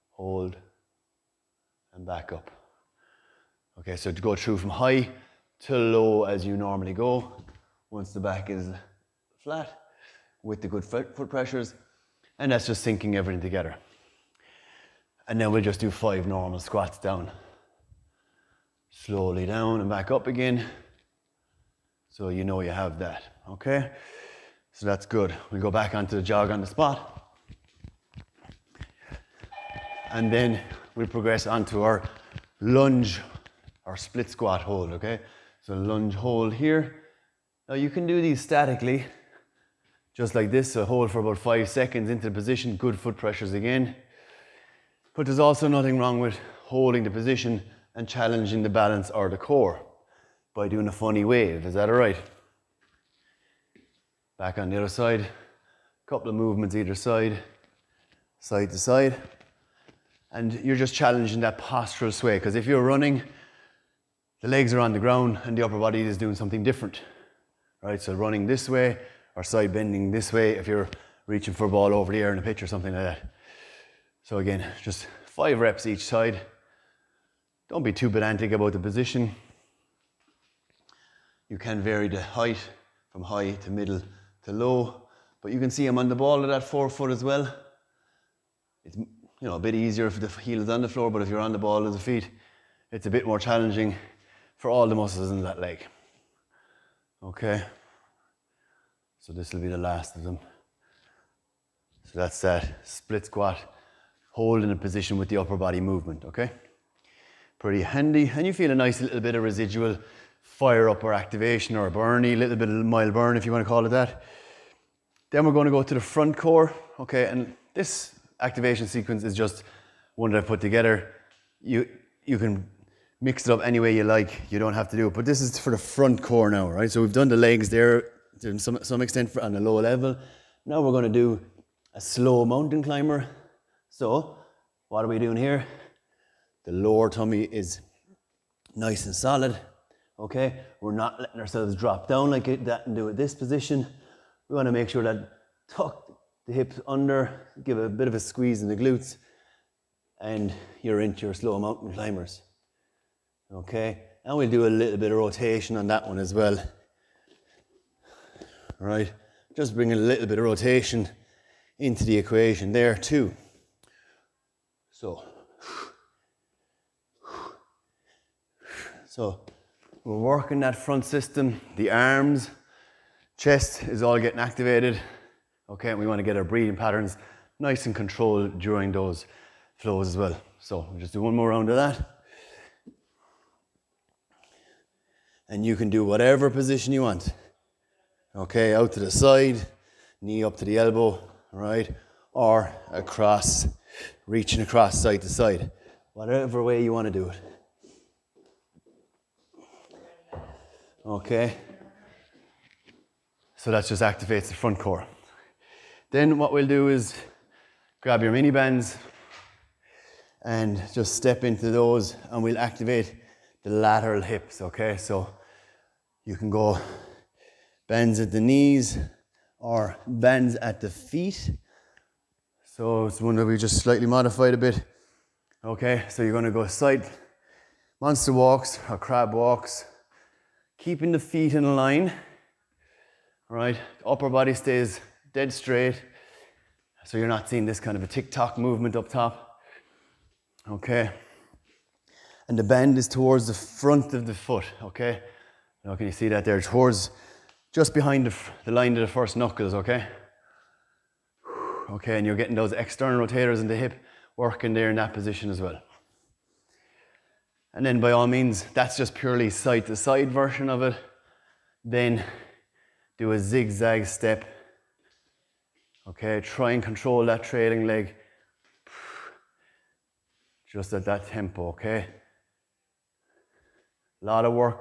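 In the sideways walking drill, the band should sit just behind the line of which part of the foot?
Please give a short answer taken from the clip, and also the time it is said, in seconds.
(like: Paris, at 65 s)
First knuckles, at 249 s.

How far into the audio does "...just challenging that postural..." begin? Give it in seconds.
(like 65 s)
60 s.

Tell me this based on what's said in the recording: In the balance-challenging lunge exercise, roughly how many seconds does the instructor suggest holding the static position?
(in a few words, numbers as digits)
5 seconds.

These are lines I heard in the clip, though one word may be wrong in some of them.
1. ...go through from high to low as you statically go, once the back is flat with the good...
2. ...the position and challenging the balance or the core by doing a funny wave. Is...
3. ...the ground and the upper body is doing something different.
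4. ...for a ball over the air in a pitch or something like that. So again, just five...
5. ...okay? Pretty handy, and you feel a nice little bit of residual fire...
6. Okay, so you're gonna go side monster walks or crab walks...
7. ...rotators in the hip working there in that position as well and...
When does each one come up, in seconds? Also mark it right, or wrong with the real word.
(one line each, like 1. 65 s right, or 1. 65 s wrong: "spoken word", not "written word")
1. 4 s wrong: "normally", not "statically"
2. 47 s right
3. 64 s right
4. 71 s right
5. 106 s right
6. 225 s right
7. 253 s right.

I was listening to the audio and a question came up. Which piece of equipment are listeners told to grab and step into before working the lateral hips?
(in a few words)
Mini bands.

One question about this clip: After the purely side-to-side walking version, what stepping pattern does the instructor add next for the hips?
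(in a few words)
Zigzag step.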